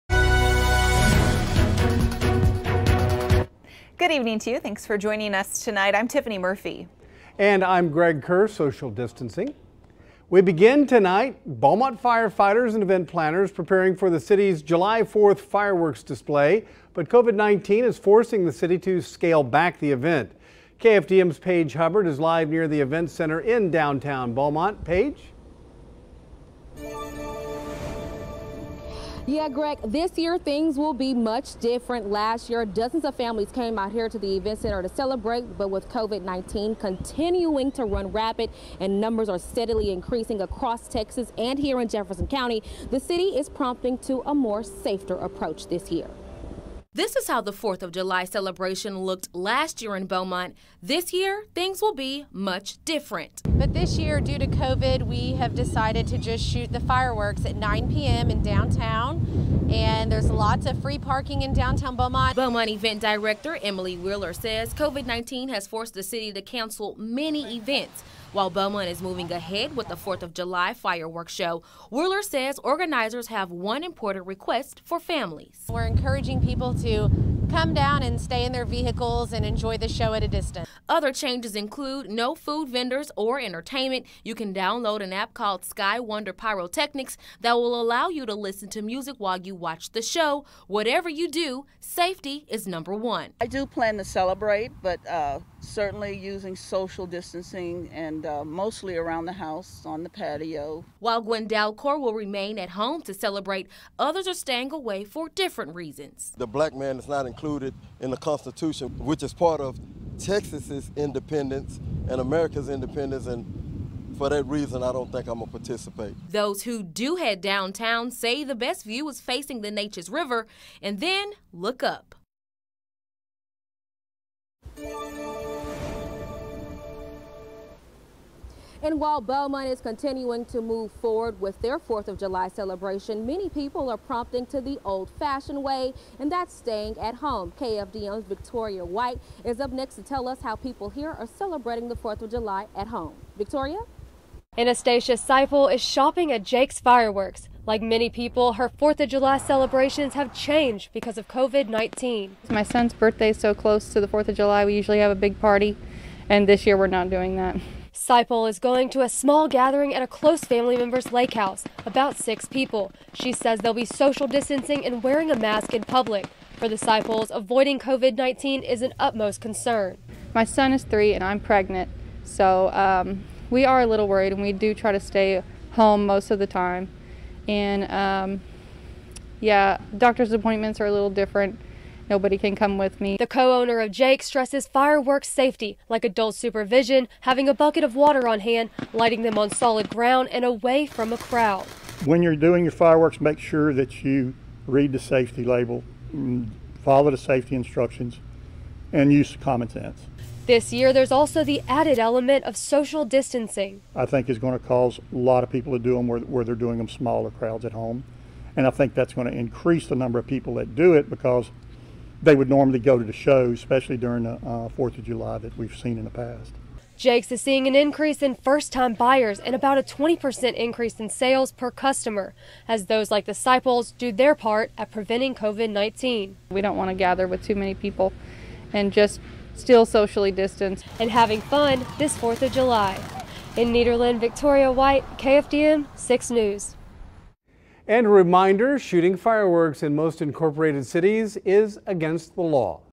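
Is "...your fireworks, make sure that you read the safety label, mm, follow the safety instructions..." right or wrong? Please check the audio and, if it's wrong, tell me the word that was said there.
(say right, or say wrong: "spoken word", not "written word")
right.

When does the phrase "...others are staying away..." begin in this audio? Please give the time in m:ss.
1:43.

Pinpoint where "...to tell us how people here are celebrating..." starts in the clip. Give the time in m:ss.
2:19.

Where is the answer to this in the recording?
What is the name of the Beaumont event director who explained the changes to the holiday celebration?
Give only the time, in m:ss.
1:03.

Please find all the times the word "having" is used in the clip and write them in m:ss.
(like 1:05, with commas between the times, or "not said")
3:07, 3:51.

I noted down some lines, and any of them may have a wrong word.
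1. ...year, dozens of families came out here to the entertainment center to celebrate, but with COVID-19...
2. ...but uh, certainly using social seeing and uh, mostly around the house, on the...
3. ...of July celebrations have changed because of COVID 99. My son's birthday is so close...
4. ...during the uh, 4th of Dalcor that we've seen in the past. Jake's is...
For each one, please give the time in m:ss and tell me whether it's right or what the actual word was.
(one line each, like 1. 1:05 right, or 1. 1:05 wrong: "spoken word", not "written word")
1. 0:32 wrong: "event", not "entertainment"
2. 1:34 wrong: "distancing", not "seeing"
3. 2:28 wrong: "19", not "99"
4. 3:33 wrong: "July", not "Dalcor".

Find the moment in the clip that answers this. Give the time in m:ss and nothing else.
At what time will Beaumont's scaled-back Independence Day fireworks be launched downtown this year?
0:57.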